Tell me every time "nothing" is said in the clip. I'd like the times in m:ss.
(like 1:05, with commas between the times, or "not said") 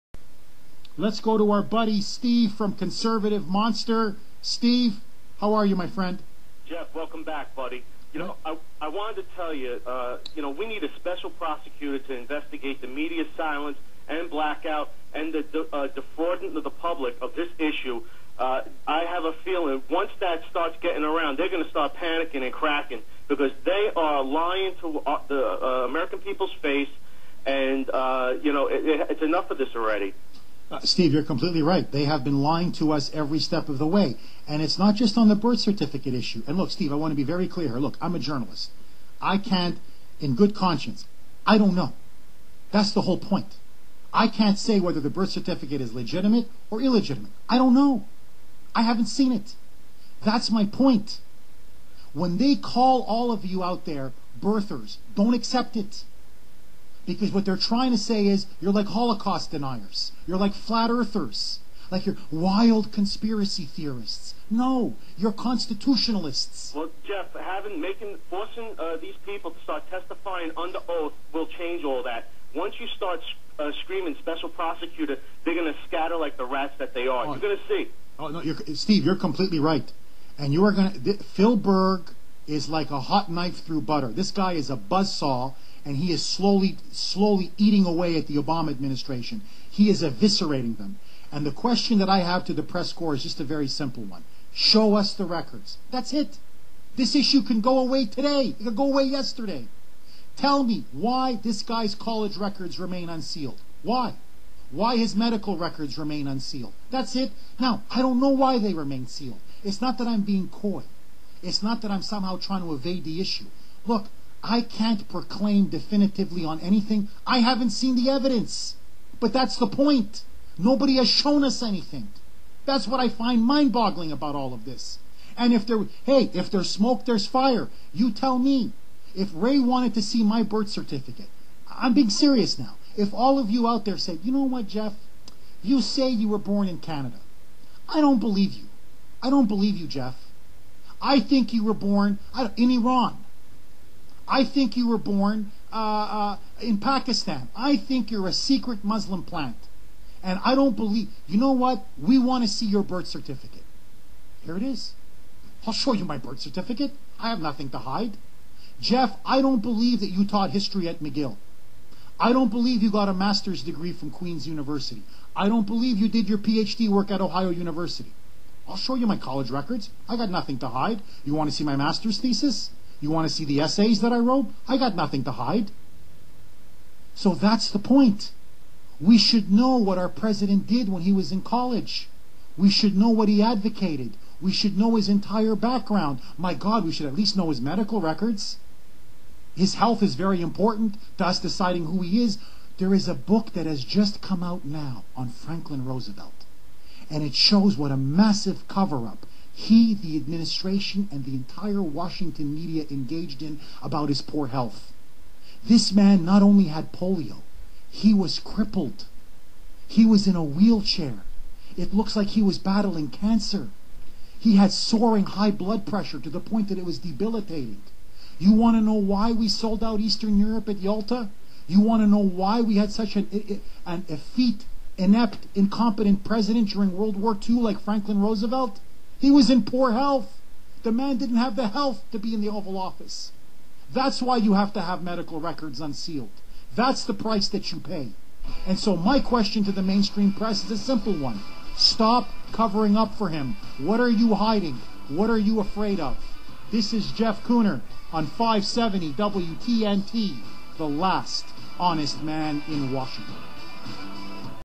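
2:37, 2:50, 2:54.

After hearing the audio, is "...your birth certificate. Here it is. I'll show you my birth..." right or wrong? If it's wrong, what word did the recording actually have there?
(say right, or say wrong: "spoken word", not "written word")
right.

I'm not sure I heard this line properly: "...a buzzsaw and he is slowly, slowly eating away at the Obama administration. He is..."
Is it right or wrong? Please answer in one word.
right.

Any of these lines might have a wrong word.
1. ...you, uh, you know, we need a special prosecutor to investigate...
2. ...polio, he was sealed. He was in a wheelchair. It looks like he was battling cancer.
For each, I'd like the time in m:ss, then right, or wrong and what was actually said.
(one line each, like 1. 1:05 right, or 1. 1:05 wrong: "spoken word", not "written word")
1. 0:09 right
2. 3:26 wrong: "crippled", not "sealed".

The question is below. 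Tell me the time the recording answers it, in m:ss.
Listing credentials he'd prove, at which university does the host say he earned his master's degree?
2:44.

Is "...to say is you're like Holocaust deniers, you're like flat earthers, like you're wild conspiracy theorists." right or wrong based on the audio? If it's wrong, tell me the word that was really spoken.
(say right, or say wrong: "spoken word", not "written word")
right.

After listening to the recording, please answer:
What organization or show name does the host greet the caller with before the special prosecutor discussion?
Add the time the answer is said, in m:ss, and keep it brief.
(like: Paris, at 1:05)
Conservative Monster, at 0:02.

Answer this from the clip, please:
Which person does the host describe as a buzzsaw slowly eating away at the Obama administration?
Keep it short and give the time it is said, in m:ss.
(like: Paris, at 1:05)
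Phil Berg, at 1:21.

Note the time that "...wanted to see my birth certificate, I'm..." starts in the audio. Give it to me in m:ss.
2:09.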